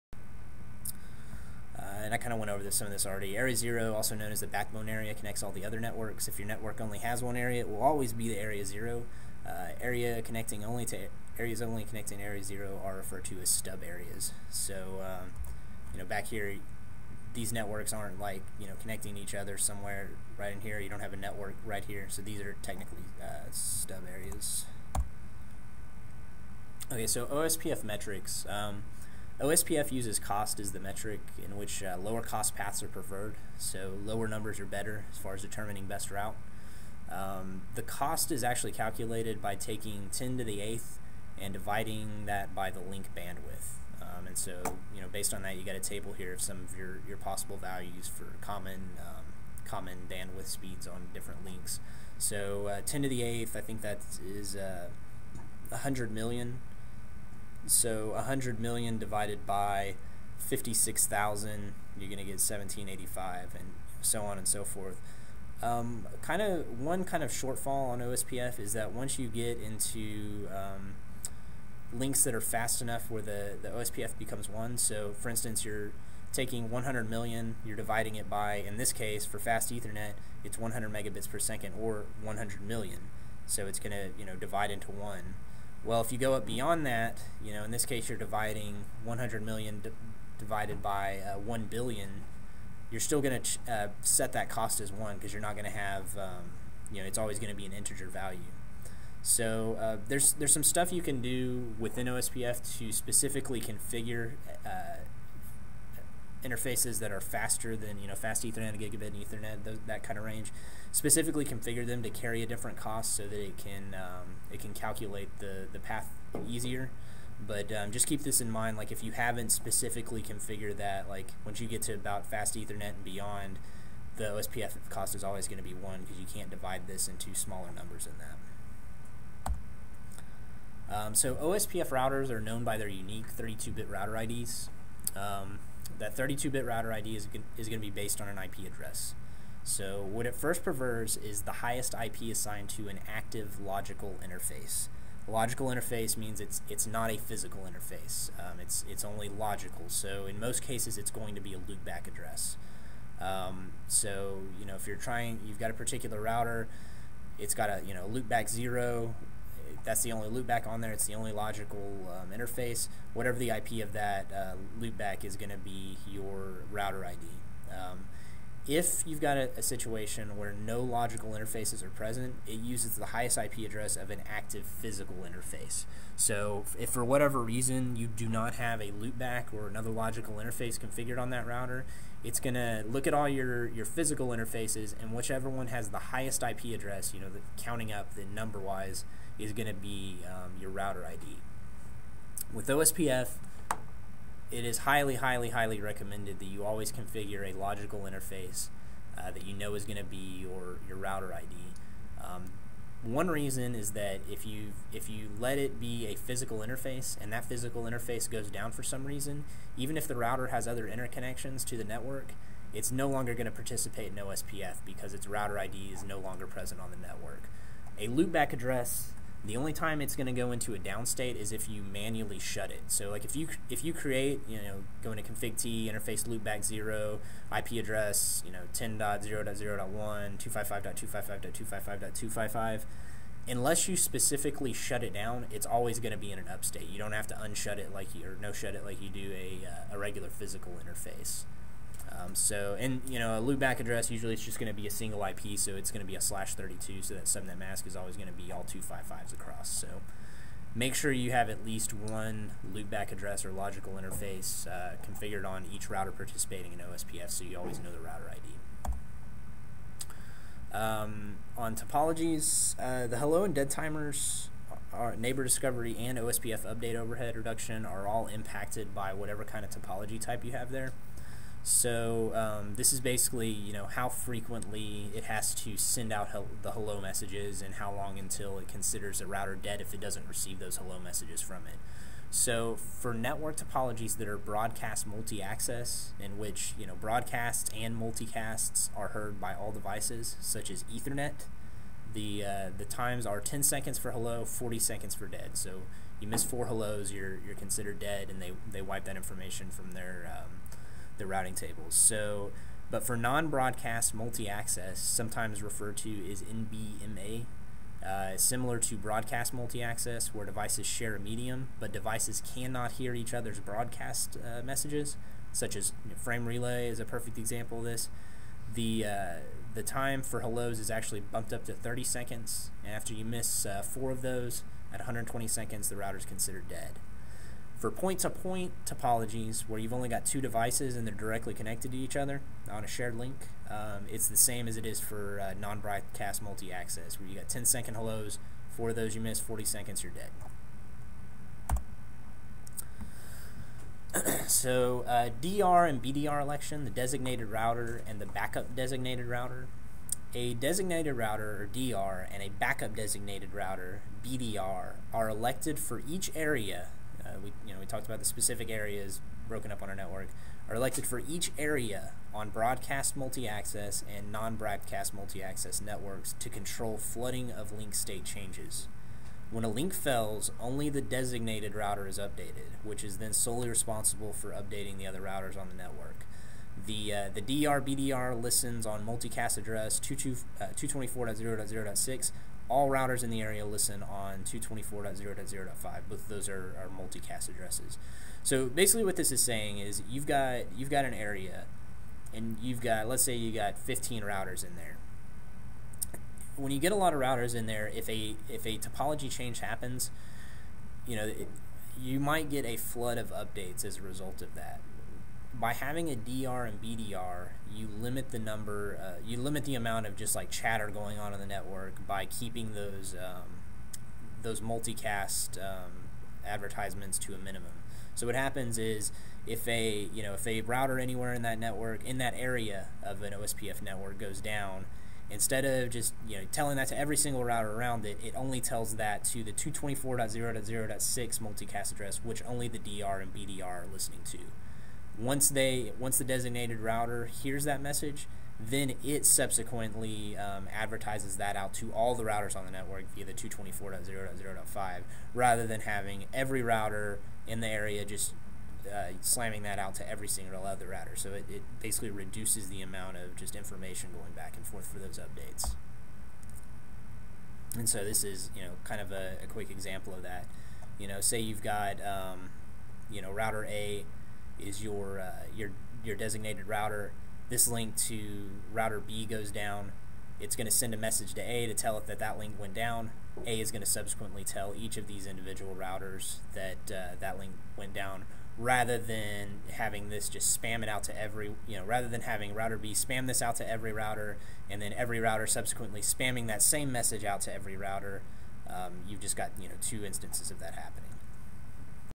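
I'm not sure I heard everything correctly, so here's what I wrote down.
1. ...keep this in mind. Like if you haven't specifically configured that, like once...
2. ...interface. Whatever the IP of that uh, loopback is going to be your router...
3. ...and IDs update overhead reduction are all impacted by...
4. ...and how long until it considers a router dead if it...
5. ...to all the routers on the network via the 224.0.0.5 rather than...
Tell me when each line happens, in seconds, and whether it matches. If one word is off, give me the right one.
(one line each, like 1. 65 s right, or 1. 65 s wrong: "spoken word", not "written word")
1. 118 s right
2. 162 s right
3. 265 s wrong: "OSPF", not "IDs"
4. 277 s right
5. 441 s right.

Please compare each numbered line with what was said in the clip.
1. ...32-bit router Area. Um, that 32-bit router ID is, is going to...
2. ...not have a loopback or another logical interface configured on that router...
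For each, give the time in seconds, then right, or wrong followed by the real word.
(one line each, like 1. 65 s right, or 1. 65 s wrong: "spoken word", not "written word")
1. 133 s wrong: "IDs", not "Area"
2. 178 s right.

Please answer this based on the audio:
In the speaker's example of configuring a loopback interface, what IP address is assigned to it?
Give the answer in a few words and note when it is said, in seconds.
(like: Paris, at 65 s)
10.0.0.1, at 228 s.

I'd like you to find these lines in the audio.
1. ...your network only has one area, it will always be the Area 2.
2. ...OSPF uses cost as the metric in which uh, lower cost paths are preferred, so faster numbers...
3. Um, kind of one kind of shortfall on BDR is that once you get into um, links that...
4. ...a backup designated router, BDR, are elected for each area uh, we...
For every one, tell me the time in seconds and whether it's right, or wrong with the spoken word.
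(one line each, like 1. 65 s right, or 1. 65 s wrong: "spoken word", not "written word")
1. 6 s wrong: "0", not "2"
2. 29 s wrong: "lower", not "faster"
3. 65 s wrong: "OSPF", not "BDR"
4. 352 s right.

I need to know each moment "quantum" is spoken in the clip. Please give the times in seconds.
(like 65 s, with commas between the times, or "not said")
not said.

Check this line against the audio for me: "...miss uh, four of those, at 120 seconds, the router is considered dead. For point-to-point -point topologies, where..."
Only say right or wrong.
right.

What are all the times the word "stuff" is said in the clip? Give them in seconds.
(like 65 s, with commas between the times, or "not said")
100 s.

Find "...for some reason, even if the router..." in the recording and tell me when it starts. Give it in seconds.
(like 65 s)
208 s.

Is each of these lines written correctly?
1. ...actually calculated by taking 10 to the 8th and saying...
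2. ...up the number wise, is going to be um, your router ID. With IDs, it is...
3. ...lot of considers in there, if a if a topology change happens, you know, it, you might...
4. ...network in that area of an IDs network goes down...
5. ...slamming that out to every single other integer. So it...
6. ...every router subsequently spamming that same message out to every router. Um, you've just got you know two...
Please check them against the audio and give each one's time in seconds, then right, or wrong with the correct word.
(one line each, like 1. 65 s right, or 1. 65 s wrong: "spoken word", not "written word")
1. 38 s wrong: "dividing", not "saying"
2. 187 s wrong: "OSPF", not "IDs"
3. 396 s wrong: "routers", not "considers"
4. 421 s wrong: "OSPF", not "IDs"
5. 449 s wrong: "router", not "integer"
6. 484 s right.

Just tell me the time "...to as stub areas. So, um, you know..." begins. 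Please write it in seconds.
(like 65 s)
13 s.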